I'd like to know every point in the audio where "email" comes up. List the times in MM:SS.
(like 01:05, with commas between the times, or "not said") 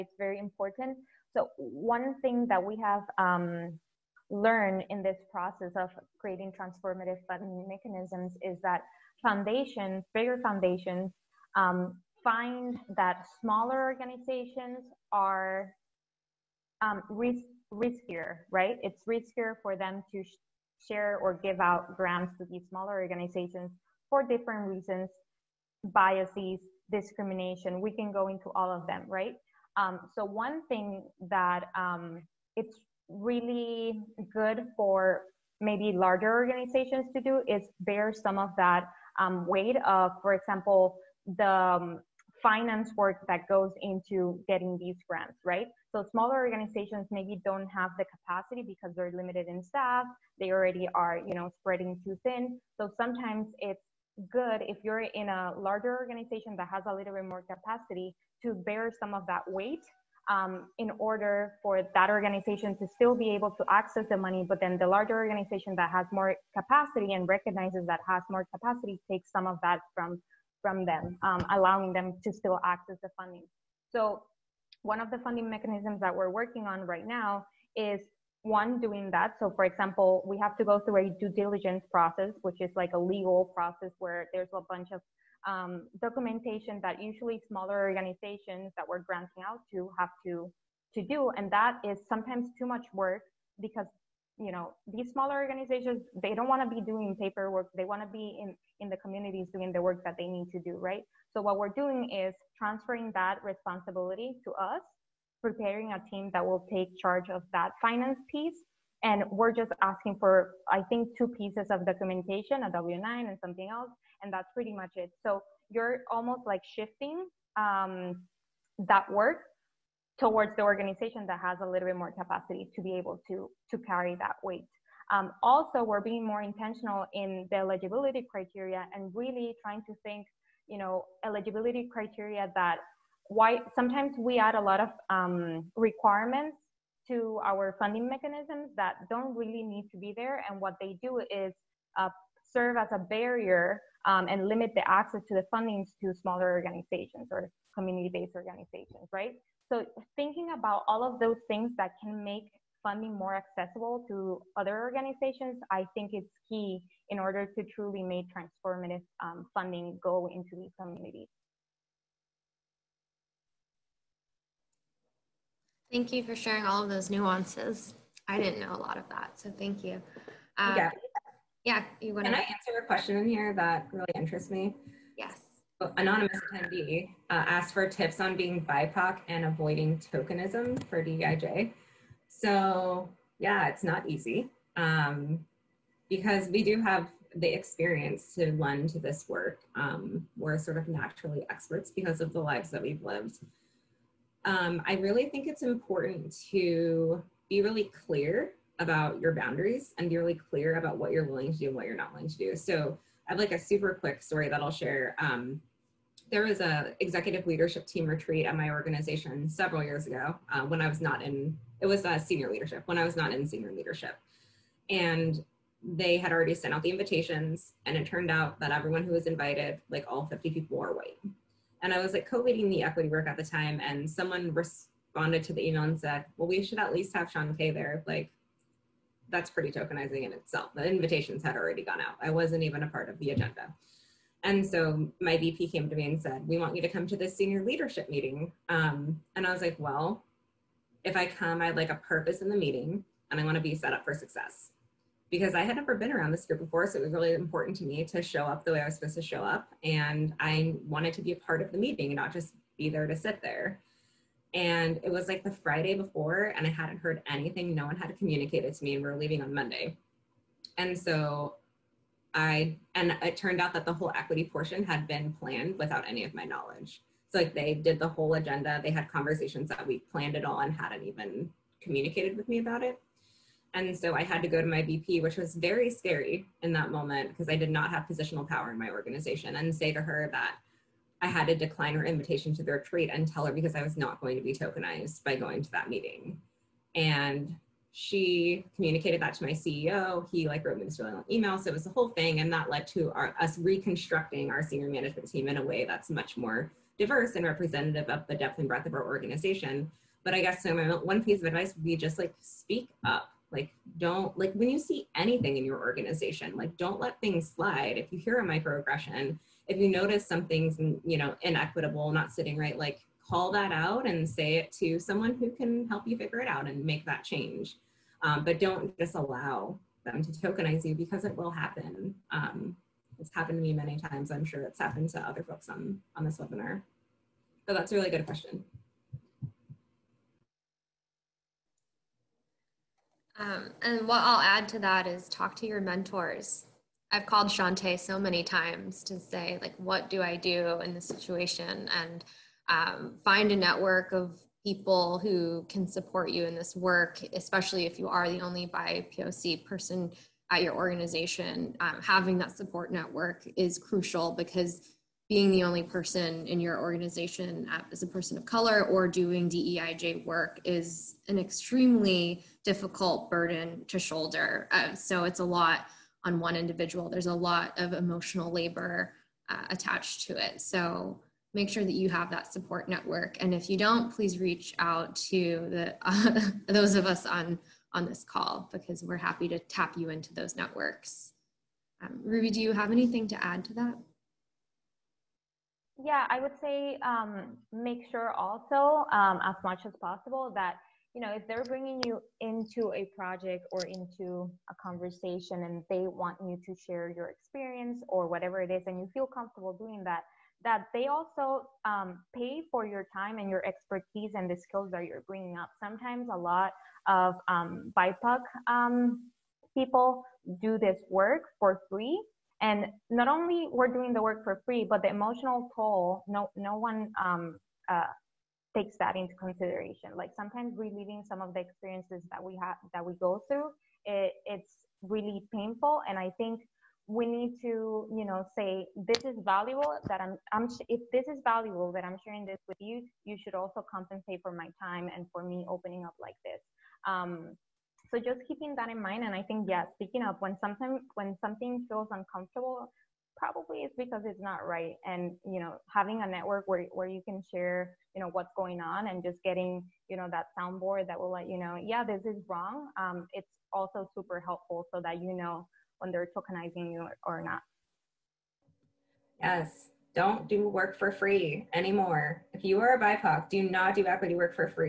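03:45, 04:51.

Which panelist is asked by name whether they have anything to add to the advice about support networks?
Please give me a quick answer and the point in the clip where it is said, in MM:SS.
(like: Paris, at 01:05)
Ruby, at 06:22.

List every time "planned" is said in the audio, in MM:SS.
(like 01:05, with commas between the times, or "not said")
04:25, 04:30.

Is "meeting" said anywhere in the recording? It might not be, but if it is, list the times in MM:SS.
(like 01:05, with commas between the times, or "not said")
03:58, 04:02, 04:11, 04:45.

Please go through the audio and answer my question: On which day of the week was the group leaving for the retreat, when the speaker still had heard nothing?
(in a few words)
Monday.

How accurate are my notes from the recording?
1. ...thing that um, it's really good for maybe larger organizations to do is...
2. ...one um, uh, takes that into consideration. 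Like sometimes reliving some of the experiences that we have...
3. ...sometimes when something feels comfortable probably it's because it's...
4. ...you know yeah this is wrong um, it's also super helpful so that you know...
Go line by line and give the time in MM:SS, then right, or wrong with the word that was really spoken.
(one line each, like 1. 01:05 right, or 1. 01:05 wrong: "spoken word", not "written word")
1. 00:30 right
2. 06:56 right
3. 07:20 wrong: "uncomfortable", not "comfortable"
4. 07:31 right.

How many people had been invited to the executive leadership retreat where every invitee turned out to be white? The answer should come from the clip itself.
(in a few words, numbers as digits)
50.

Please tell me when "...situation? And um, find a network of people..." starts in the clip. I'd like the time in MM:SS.
05:41.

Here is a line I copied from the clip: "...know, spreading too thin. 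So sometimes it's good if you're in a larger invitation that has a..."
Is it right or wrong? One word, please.
wrong.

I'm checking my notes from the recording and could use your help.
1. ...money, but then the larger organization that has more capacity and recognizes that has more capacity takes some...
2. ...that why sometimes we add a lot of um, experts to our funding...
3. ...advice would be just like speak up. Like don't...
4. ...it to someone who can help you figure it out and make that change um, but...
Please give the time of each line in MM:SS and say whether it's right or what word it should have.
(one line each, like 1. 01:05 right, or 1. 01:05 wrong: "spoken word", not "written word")
1. 01:04 right
2. 02:12 wrong: "requirements", not "experts"
3. 05:01 right
4. 05:14 right.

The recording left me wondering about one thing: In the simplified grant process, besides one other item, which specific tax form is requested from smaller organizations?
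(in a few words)
W9.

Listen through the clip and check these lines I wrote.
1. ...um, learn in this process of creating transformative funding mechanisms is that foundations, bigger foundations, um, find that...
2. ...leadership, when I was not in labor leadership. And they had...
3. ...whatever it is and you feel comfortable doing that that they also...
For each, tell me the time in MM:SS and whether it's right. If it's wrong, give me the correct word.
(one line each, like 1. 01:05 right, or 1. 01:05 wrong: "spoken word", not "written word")
1. 00:03 right
2. 03:32 wrong: "senior", not "labor"
3. 06:38 right.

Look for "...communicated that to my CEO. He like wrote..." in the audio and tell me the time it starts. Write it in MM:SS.
04:48.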